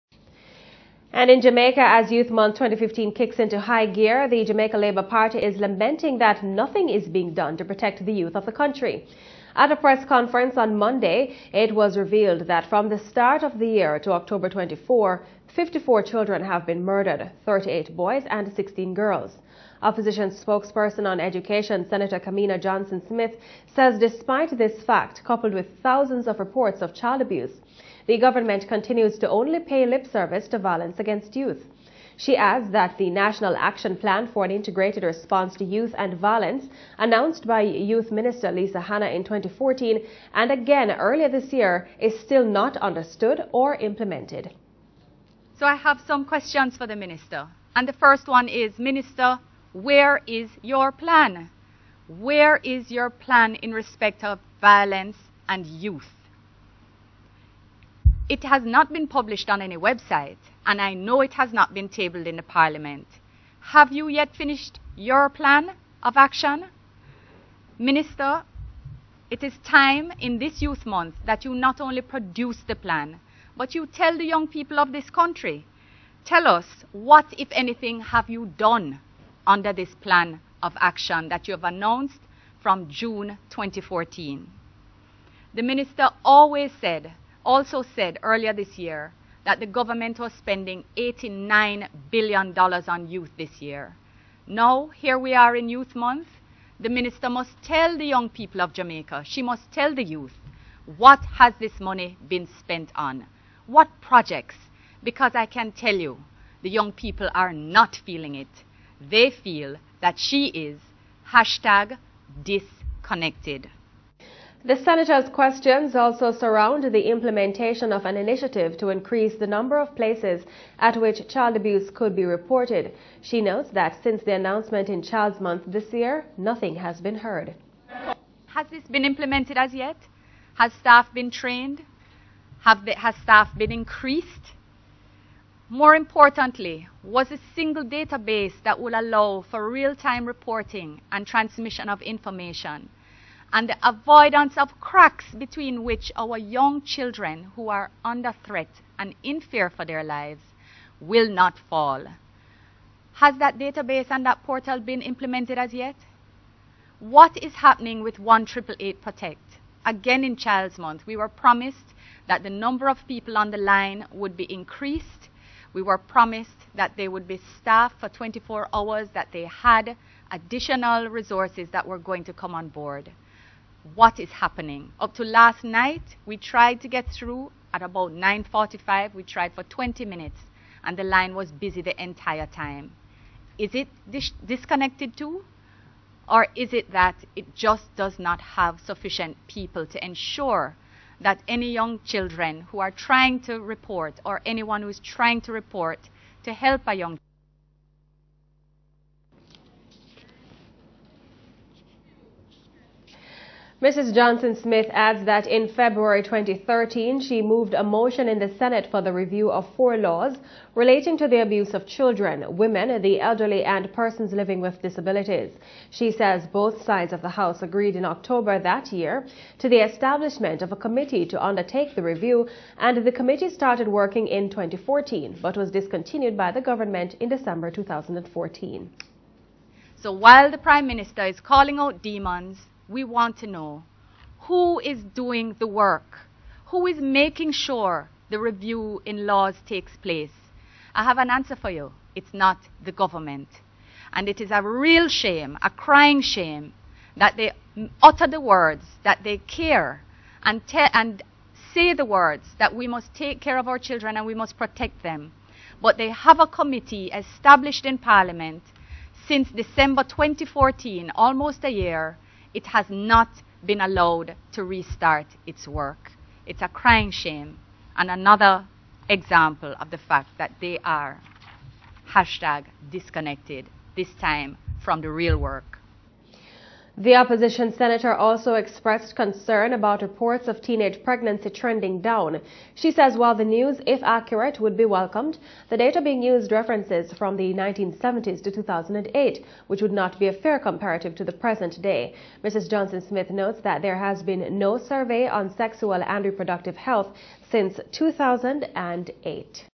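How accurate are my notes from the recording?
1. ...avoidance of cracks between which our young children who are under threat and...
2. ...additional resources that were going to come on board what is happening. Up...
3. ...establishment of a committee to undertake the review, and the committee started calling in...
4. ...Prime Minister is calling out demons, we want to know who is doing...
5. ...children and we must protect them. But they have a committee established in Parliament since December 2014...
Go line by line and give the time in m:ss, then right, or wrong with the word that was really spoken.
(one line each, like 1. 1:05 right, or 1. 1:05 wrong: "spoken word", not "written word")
1. 2:23 right
2. 2:50 right
3. 3:39 wrong: "working", not "calling"
4. 3:50 right
5. 4:13 right.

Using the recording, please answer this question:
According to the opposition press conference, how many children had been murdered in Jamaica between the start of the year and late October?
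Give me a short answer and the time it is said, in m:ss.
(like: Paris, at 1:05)
54, at 0:15.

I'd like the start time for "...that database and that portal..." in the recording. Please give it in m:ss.
2:33.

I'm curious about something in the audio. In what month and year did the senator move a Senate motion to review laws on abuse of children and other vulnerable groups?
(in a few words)
February 2013.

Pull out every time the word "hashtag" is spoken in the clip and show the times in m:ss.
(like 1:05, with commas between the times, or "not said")
1:51, 4:32.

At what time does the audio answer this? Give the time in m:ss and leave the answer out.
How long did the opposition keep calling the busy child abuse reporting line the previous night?
2:59.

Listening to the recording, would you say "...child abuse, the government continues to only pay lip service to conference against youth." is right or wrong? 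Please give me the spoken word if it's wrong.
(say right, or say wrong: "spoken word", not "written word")
wrong: "violence", not "conference".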